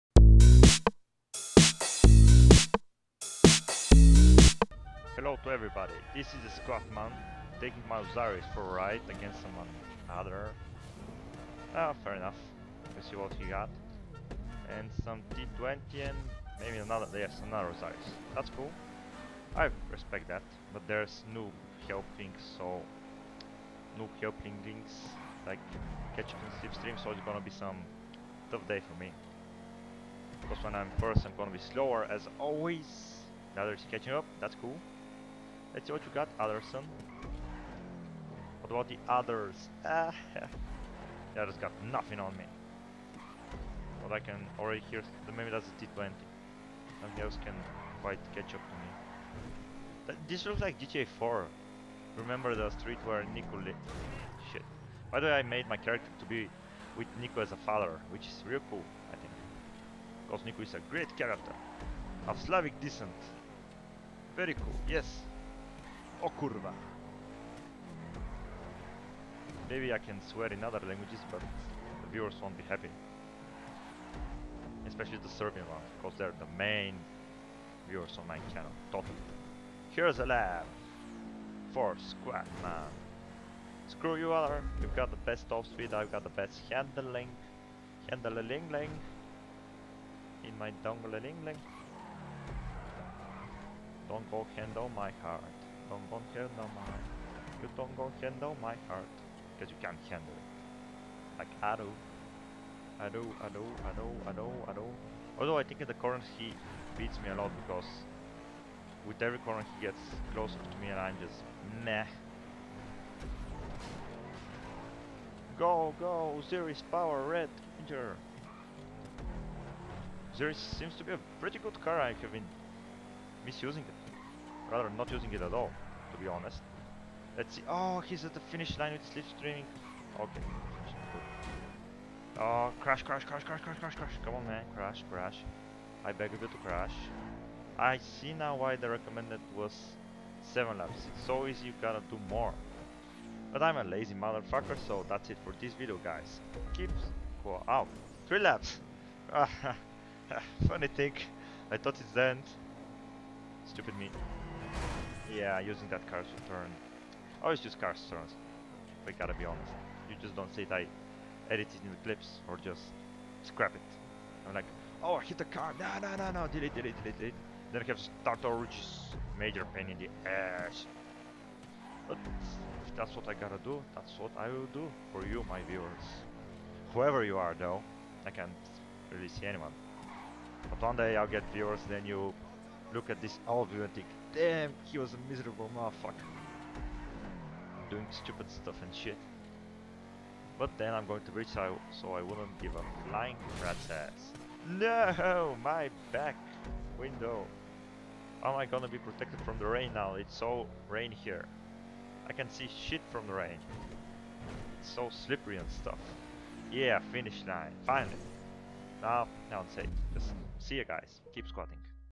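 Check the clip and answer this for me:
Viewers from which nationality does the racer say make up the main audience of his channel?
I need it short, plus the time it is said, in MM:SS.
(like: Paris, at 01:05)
Serbian, at 01:15.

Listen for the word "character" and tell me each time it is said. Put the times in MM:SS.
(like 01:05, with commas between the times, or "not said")
00:55, 01:01.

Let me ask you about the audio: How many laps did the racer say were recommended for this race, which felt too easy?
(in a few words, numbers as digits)
7.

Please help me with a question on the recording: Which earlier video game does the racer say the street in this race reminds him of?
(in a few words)
GTA 4.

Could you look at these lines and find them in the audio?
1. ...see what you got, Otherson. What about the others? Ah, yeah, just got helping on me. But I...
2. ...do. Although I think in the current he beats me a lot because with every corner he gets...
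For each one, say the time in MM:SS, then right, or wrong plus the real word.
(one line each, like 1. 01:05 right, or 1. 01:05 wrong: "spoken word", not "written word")
1. 00:35 wrong: "nothing", not "helping"
2. 01:44 right.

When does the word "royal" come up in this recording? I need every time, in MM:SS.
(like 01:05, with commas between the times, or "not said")
not said.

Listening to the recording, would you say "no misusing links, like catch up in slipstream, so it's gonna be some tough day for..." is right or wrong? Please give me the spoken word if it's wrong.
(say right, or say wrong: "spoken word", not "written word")
wrong: "helping", not "misusing".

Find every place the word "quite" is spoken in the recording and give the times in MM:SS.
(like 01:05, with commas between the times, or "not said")
00:48.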